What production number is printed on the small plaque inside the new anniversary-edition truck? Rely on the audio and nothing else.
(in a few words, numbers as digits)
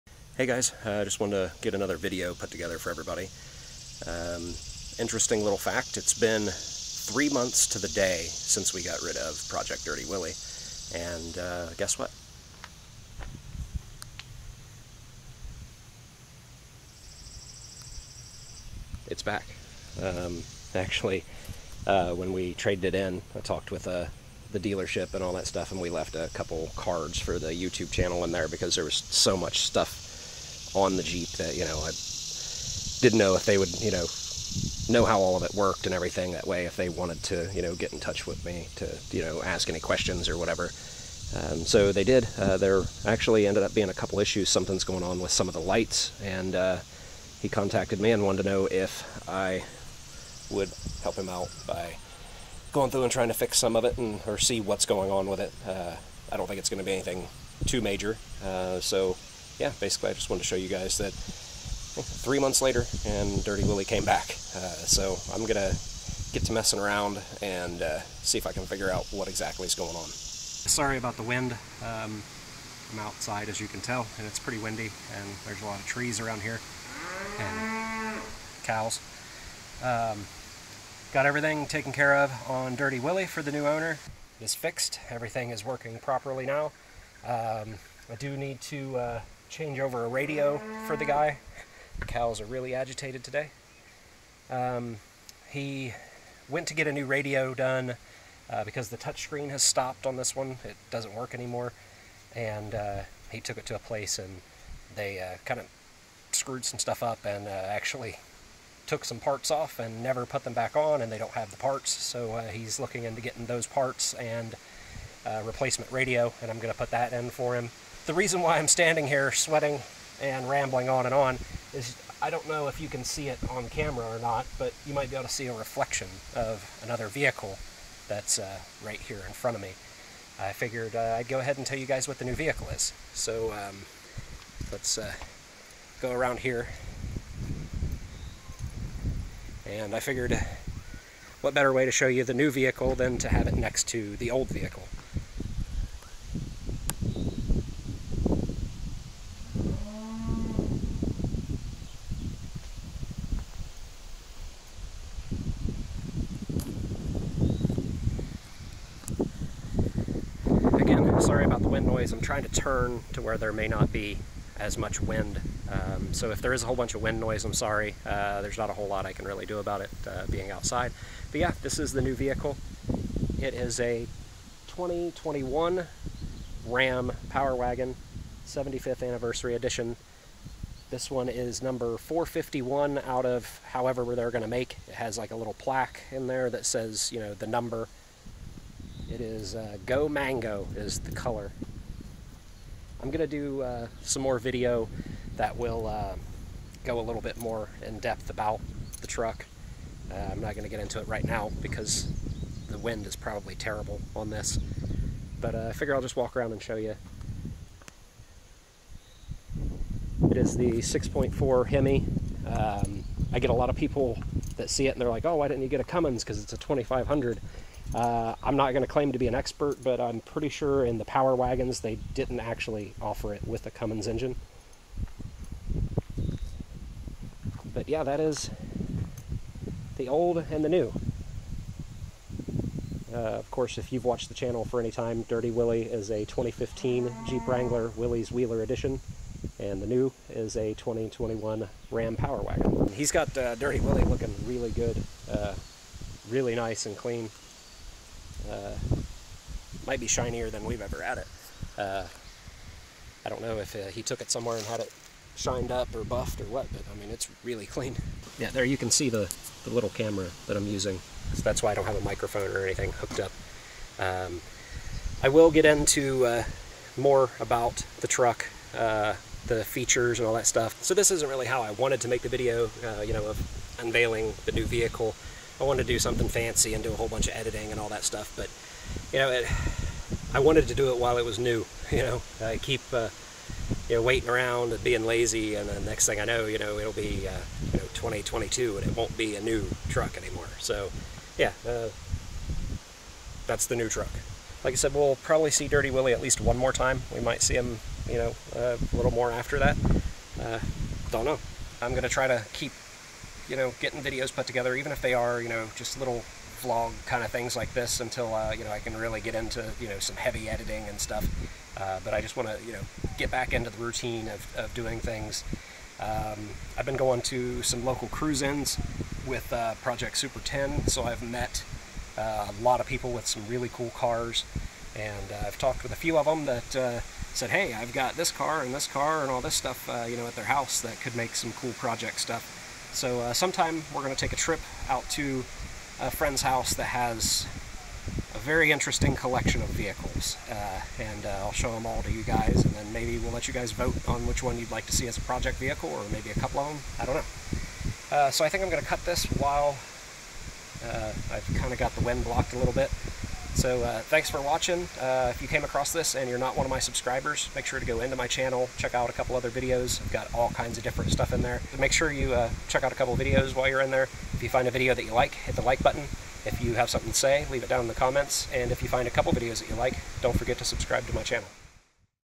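451.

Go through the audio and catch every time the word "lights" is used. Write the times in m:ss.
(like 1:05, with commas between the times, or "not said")
0:45.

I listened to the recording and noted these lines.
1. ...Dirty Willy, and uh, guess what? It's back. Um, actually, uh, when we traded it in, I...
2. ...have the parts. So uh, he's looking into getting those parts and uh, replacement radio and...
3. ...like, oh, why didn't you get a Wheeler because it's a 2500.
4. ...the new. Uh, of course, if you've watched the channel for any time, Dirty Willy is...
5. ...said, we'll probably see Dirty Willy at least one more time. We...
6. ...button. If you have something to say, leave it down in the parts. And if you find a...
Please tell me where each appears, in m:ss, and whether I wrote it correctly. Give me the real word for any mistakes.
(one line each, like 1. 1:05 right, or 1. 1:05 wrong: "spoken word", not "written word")
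1. 0:09 right
2. 1:51 right
3. 3:35 wrong: "Cummins", not "Wheeler"
4. 3:50 right
5. 4:54 right
6. 6:05 wrong: "comments", not "parts".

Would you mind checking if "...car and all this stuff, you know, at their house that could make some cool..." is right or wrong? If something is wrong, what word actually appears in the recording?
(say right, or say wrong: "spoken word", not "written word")
right.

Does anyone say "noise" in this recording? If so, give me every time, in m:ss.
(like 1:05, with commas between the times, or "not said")
2:41, 2:47.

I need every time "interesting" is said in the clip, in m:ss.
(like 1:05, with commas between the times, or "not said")
0:04, 5:38.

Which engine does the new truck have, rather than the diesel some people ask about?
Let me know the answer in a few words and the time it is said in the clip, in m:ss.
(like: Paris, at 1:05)
6.4 Hemi, at 3:30.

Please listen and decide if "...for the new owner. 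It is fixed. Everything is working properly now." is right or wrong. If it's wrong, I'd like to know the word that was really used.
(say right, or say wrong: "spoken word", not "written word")
right.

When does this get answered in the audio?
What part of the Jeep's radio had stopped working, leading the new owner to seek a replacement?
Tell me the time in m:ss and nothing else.
1:38.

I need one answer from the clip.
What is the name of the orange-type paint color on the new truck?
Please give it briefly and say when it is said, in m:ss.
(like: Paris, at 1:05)
Go Mango, at 3:09.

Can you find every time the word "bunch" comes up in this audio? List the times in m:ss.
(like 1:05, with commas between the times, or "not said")
2:46, 4:37.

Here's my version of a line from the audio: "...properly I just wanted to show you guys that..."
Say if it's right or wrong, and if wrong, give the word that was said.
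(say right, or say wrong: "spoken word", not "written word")
wrong: "basically", not "properly".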